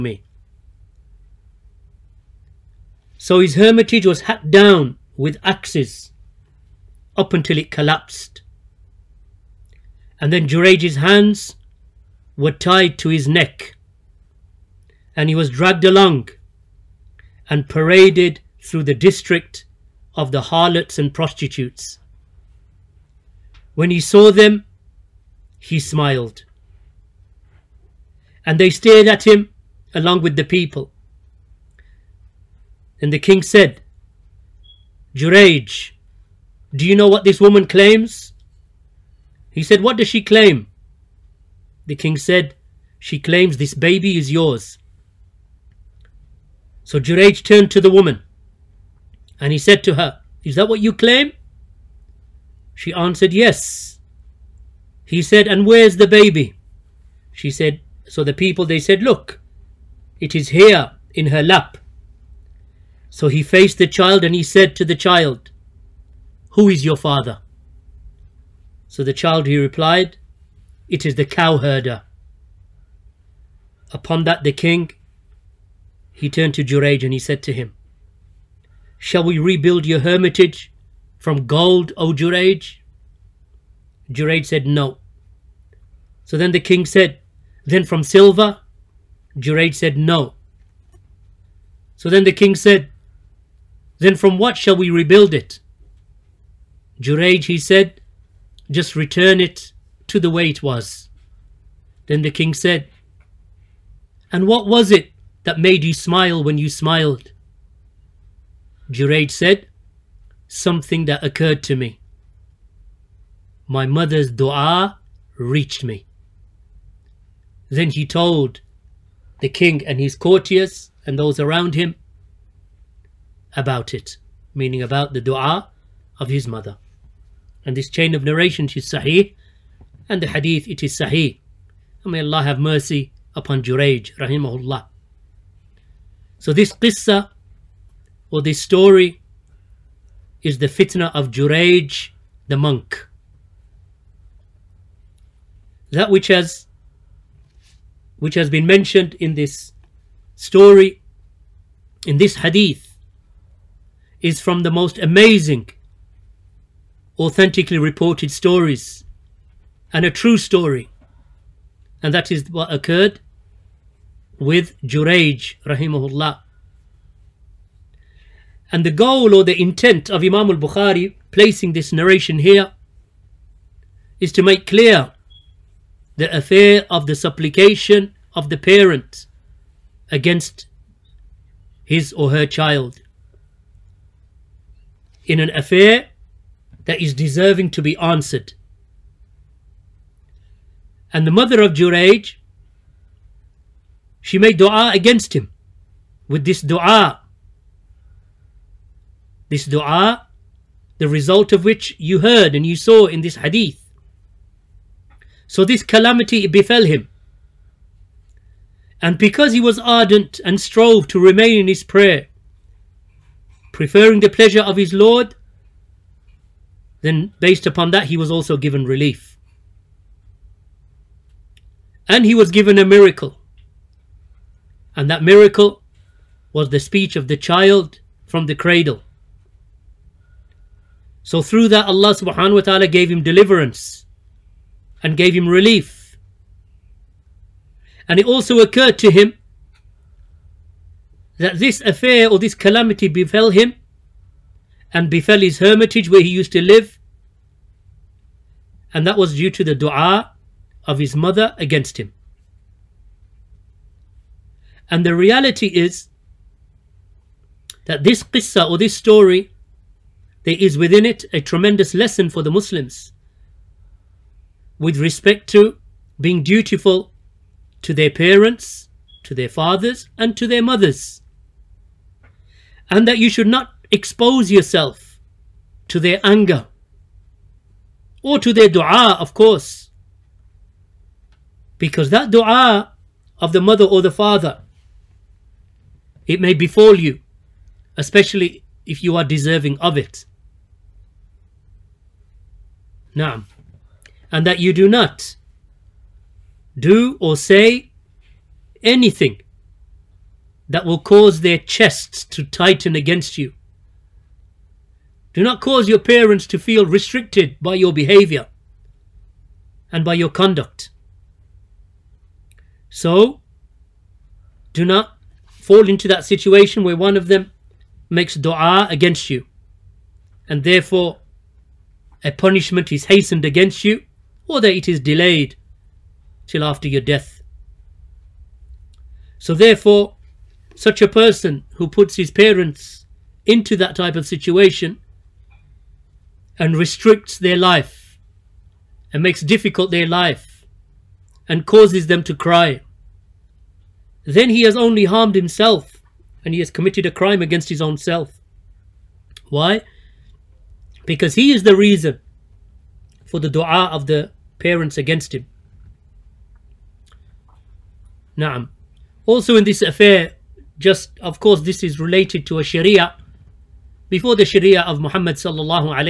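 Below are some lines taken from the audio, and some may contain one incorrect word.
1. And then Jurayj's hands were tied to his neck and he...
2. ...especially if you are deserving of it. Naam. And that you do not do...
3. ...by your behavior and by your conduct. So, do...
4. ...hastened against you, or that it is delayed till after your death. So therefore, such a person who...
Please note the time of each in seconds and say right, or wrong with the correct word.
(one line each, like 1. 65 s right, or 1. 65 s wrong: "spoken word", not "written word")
1. 10 s right
2. 287 s right
3. 307 s right
4. 323 s right.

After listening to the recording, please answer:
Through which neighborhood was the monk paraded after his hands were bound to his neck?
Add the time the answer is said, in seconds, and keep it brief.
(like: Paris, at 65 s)
District of the harlots and prostitutes, at 18 s.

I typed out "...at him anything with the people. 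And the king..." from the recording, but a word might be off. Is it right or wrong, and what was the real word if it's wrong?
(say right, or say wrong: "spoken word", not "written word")
wrong: "along", not "anything".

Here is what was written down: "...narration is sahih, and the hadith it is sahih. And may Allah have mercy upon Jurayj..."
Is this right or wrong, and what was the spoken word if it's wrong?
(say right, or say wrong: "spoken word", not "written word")
right.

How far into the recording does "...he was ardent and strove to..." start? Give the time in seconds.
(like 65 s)
209 s.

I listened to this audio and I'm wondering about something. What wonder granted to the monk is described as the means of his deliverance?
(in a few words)
Speech of the child from the cradle.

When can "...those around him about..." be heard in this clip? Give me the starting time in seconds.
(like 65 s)
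121 s.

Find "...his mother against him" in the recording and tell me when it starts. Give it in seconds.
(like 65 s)
250 s.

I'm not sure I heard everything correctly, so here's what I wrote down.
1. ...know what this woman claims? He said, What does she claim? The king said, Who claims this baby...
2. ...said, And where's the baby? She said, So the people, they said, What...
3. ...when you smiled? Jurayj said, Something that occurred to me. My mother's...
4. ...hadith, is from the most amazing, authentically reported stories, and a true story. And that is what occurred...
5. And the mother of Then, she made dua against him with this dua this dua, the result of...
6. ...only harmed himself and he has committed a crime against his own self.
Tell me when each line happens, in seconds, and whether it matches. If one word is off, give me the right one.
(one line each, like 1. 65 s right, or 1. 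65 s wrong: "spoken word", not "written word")
1. 36 s wrong: "She", not "Who"
2. 55 s wrong: "Look", not "What"
3. 106 s right
4. 152 s right
5. 191 s wrong: "Jurayj", not "Then"
6. 344 s right.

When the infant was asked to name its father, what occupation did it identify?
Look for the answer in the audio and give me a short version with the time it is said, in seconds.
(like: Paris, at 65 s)
Cowherder, at 71 s.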